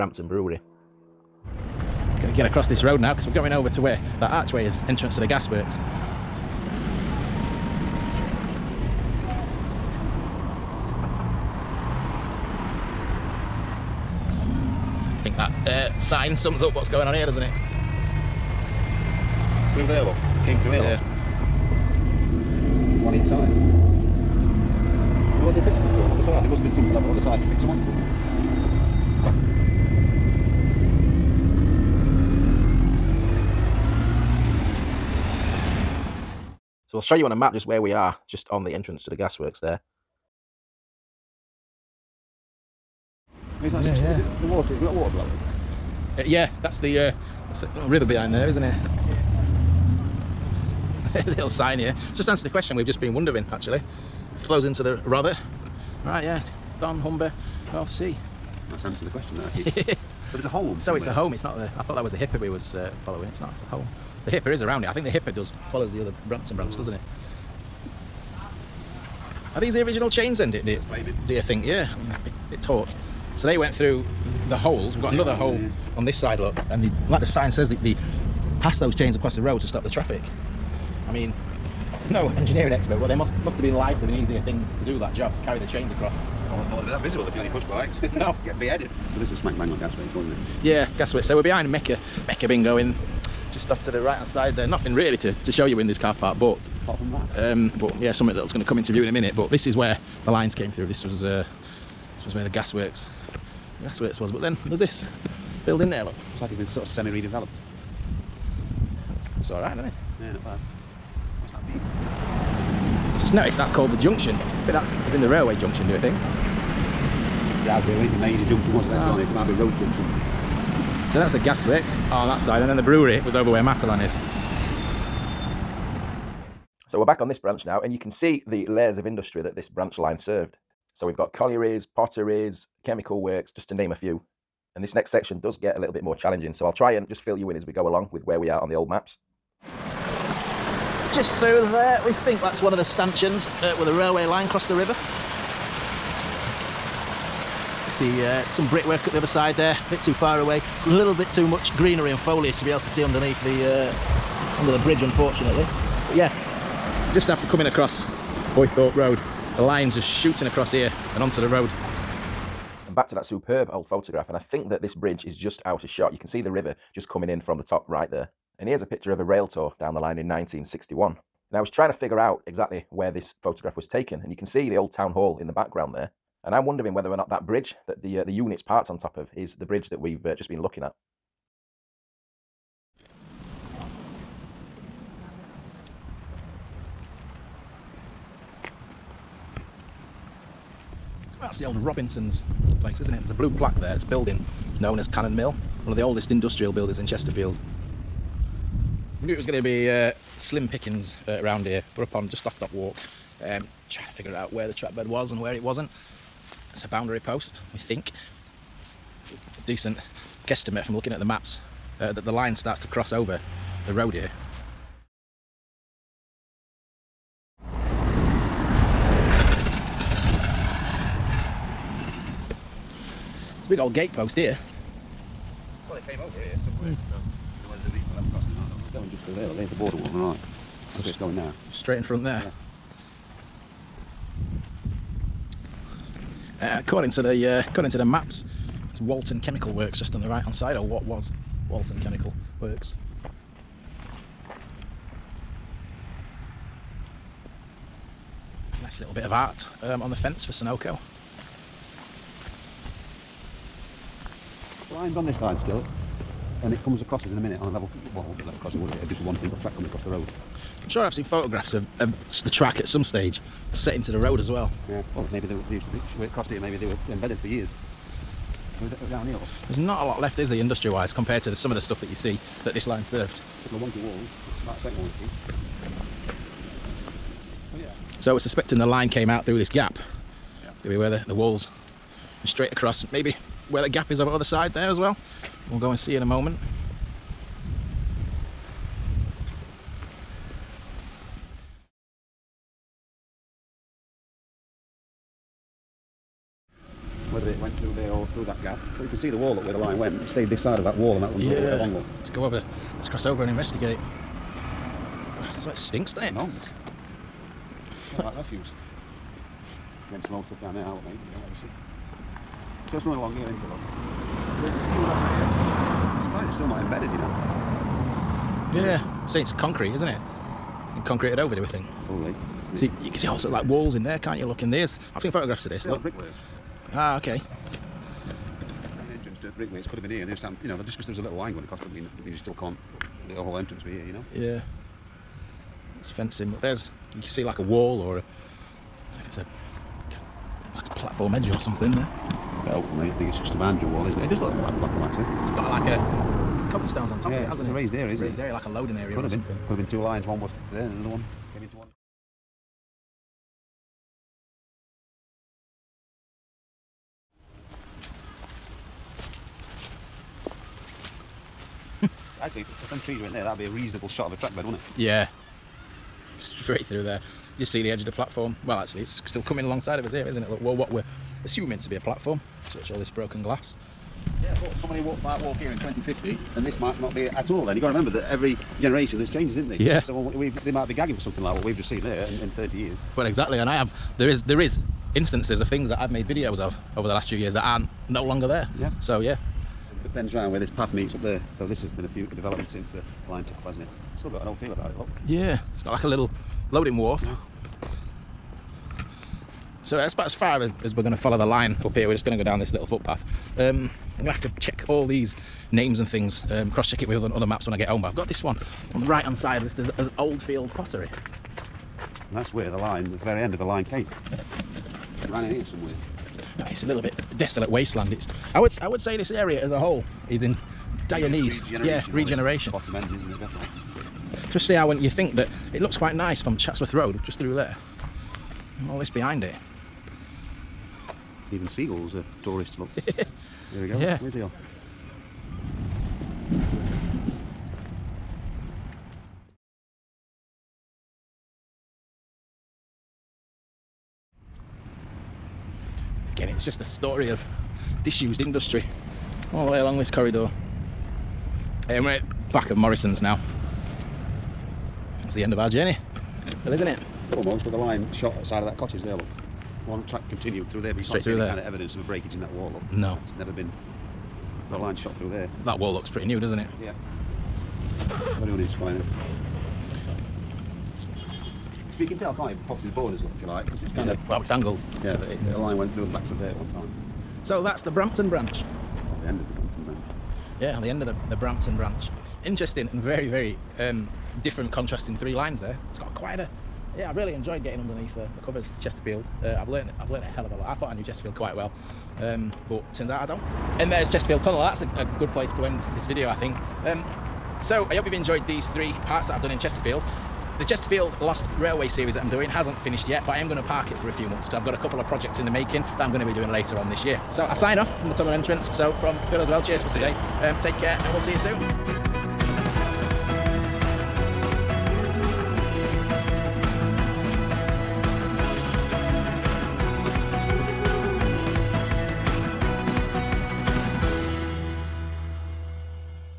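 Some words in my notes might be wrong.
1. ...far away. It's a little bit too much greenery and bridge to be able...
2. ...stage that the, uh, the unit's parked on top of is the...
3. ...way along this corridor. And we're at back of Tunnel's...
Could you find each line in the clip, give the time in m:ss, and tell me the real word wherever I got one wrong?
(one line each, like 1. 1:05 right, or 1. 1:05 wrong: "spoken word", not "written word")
1. 2:30 wrong: "foliage", not "bridge"
2. 2:57 wrong: "bridge", not "stage"
3. 7:29 wrong: "Morrison", not "Tunnel".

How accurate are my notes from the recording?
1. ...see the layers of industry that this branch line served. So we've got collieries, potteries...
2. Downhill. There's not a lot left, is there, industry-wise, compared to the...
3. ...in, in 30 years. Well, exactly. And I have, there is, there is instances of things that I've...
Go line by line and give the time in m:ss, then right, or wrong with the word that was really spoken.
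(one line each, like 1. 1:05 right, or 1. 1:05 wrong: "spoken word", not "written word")
1. 2:08 right
2. 4:29 right
3. 6:22 right.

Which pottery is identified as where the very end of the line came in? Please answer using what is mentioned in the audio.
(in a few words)
Oldfield pottery.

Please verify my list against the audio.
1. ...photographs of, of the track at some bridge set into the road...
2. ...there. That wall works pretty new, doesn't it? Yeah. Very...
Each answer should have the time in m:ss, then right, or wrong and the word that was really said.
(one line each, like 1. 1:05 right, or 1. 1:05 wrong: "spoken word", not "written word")
1. 4:21 wrong: "stage", not "bridge"
2. 7:45 wrong: "looks", not "works".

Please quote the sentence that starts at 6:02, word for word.
See, if, if them trees were in there, that'd be a reasonable shot of a track bed, wouldn't it?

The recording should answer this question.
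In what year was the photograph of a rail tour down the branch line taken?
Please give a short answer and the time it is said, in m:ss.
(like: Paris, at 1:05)
1961, at 2:50.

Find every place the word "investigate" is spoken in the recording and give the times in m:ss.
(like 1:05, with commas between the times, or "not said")
5:03.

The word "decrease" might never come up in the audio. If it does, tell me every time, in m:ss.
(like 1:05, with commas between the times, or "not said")
not said.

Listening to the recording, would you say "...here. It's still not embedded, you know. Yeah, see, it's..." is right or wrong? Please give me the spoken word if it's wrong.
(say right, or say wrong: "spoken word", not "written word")
right.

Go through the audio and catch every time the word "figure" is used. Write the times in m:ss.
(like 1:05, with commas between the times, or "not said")
2:51, 3:24.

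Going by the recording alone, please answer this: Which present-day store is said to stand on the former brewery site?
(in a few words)
Matalan.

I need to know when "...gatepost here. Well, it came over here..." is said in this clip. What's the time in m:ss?
3:43.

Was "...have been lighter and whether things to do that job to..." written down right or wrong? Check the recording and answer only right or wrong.
wrong.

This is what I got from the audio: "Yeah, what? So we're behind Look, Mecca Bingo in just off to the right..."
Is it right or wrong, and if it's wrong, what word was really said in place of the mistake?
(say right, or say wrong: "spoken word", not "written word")
wrong: "Mecca", not "Look".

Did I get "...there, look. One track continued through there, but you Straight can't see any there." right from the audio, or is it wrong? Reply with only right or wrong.
right.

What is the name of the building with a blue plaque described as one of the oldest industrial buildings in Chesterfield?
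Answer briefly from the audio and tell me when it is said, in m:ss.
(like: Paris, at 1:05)
Cannon Mill, at 3:15.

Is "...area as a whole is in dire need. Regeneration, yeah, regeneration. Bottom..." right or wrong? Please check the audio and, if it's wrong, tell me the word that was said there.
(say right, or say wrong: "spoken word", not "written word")
right.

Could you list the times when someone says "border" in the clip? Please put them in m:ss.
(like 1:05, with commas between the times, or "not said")
3:49, 7:52.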